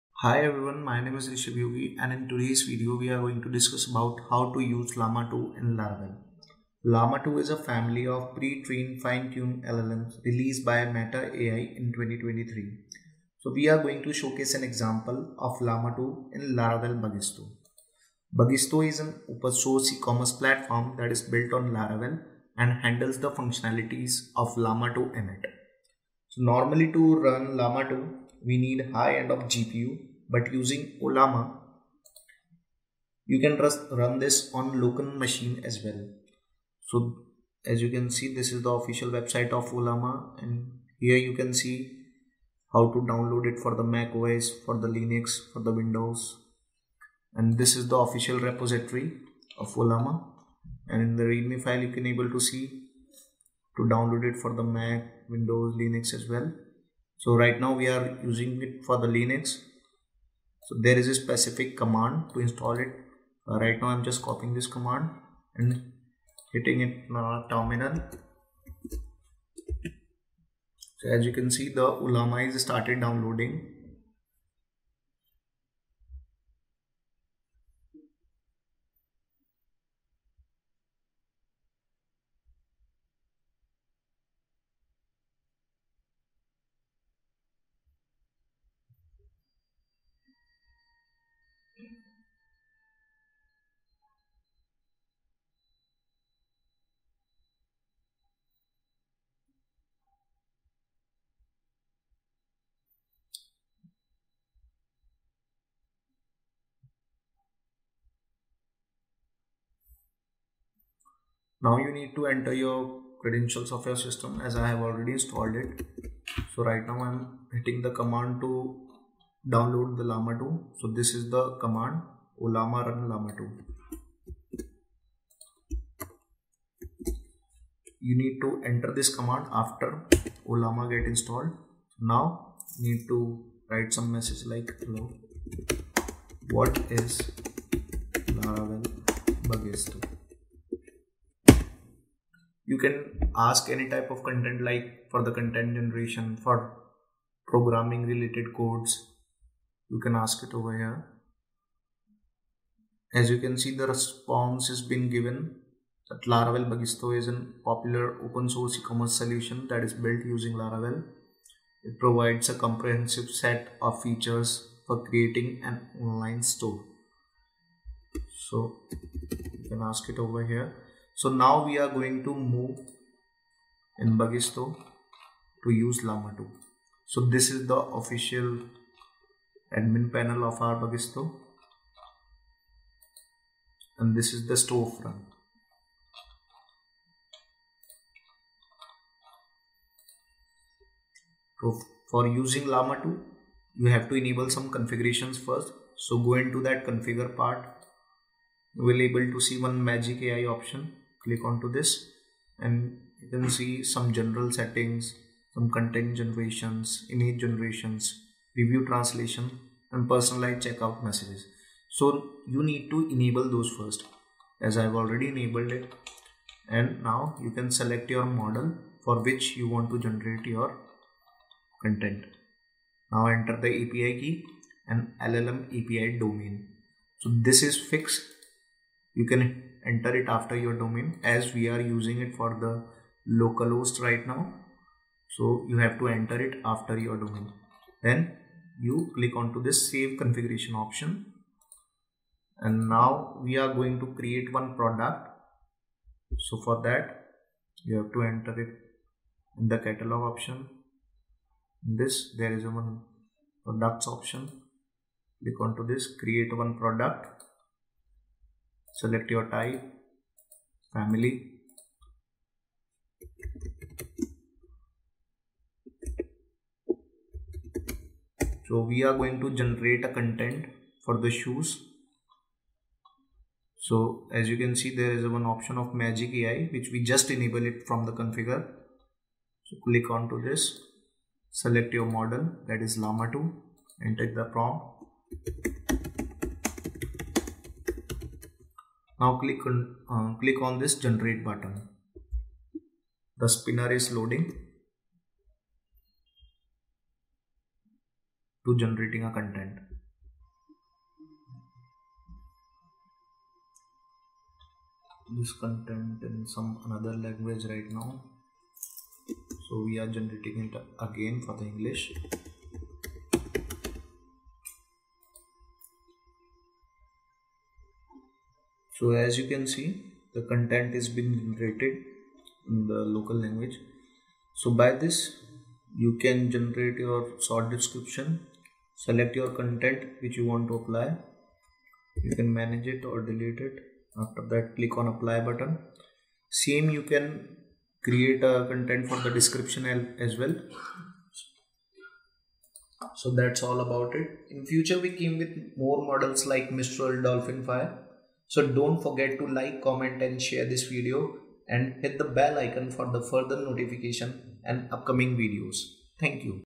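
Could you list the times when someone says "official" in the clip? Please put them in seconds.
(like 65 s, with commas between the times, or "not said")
38 s, 47 s, 177 s.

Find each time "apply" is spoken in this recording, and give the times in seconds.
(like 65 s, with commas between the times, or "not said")
330 s, 335 s.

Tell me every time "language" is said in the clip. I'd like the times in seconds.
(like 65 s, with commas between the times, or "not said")
307 s, 323 s.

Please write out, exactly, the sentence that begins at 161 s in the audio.
It provides a comprehensive set of features for creating an online store.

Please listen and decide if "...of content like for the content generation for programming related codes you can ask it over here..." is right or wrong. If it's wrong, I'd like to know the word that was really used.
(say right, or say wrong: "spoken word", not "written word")
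right.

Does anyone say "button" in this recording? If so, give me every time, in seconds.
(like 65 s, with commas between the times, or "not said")
291 s, 335 s.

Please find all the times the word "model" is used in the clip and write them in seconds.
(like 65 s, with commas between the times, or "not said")
218 s, 282 s, 346 s.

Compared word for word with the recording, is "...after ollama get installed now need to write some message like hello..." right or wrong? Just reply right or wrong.
right.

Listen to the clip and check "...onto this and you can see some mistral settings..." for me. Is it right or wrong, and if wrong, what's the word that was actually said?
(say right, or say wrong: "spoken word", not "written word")
wrong: "general", not "mistral".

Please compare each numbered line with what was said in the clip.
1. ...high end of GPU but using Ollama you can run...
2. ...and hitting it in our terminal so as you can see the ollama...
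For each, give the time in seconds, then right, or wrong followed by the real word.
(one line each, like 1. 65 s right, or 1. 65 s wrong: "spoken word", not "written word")
1. 28 s right
2. 65 s right.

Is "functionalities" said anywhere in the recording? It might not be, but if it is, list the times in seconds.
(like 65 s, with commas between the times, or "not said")
23 s.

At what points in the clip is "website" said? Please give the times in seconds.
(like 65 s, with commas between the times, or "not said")
39 s.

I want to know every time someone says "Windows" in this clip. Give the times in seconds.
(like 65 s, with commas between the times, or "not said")
45 s, 55 s.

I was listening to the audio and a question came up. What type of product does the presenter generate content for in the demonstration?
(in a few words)
Shoes.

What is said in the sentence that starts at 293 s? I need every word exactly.
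The spinner is loading to generating a content.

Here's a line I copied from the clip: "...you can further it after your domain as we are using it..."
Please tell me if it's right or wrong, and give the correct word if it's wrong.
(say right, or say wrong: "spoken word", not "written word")
wrong: "enter", not "further".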